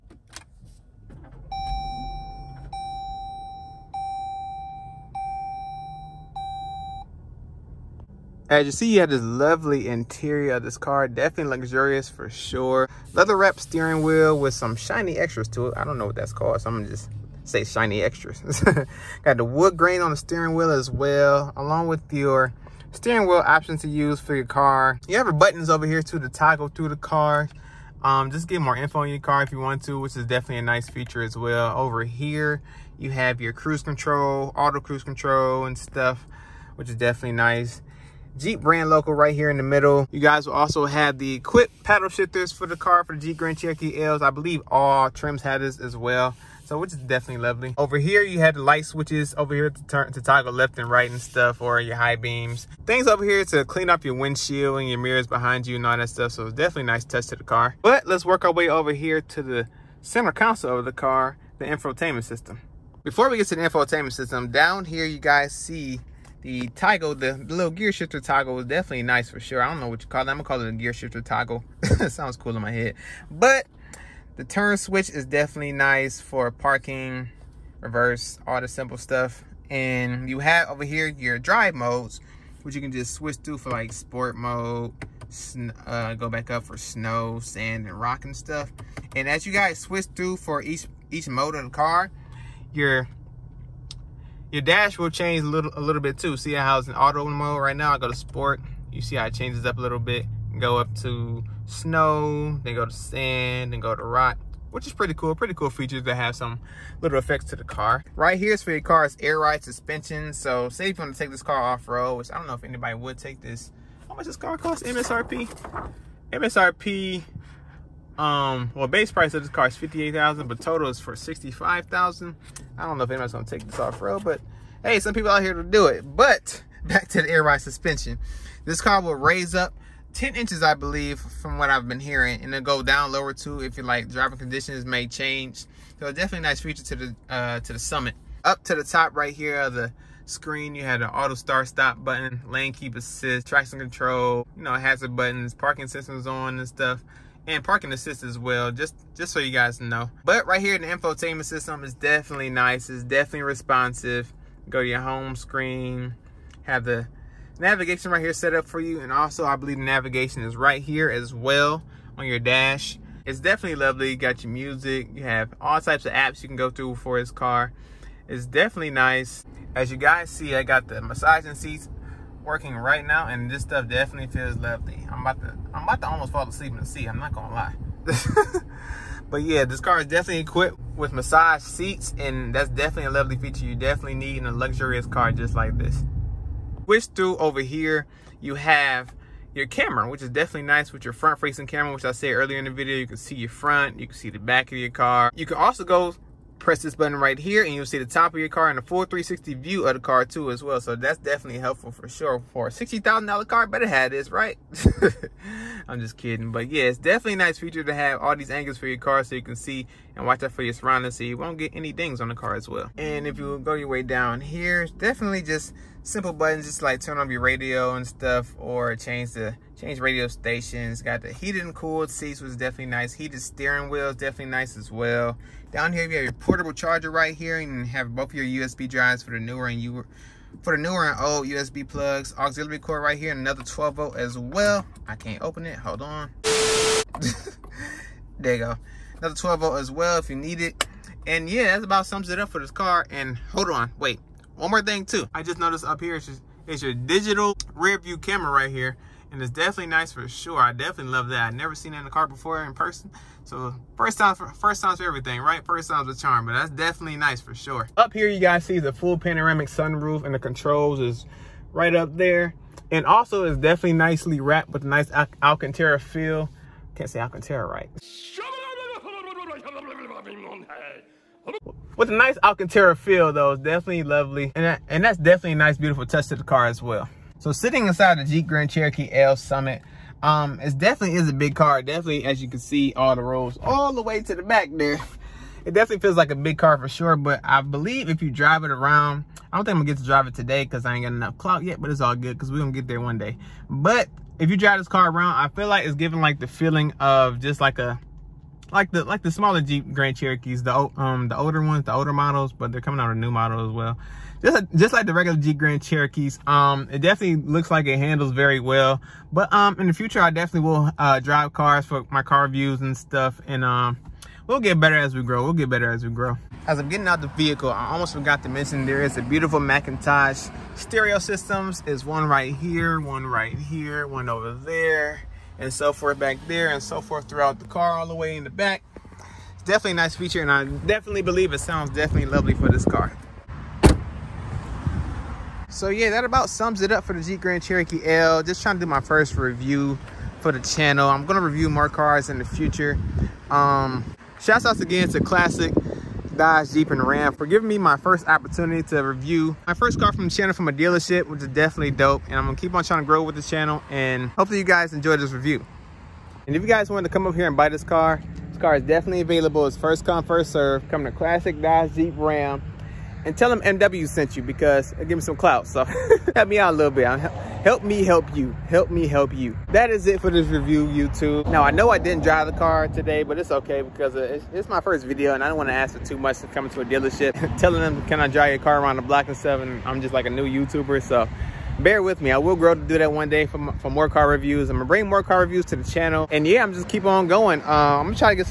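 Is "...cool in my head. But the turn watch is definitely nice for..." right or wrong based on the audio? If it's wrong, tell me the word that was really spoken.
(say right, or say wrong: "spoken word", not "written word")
wrong: "switch", not "watch".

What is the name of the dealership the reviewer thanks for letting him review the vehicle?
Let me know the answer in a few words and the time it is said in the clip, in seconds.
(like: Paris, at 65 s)
Classic Dodge, Jeep, and Ram, at 345 s.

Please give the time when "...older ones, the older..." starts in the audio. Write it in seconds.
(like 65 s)
301 s.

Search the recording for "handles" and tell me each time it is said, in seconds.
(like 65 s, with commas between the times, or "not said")
307 s.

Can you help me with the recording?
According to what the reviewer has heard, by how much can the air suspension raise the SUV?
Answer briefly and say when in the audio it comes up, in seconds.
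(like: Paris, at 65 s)
10 inches, at 130 s.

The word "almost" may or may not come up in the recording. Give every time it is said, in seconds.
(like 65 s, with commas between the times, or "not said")
176 s, 317 s.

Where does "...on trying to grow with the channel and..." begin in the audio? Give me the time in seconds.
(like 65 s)
352 s.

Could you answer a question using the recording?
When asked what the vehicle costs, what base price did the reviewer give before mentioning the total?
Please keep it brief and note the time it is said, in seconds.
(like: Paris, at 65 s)
$58,000, at 119 s.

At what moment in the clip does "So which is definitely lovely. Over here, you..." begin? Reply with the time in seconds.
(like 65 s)
46 s.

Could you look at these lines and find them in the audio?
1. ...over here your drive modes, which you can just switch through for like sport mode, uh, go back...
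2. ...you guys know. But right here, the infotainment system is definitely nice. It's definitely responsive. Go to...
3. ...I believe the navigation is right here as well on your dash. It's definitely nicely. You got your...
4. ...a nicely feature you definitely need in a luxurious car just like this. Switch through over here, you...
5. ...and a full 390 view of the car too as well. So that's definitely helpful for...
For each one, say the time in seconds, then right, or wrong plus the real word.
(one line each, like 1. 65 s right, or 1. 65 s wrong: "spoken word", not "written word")
1. 80 s right
2. 149 s right
3. 159 s wrong: "lovely", not "nicely"
4. 183 s wrong: "lovely", not "nicely"
5. 198 s wrong: "360", not "390".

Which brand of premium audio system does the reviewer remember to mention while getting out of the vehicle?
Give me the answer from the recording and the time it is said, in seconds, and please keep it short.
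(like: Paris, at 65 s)
McIntosh, at 319 s.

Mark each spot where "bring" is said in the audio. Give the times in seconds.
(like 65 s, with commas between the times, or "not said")
384 s.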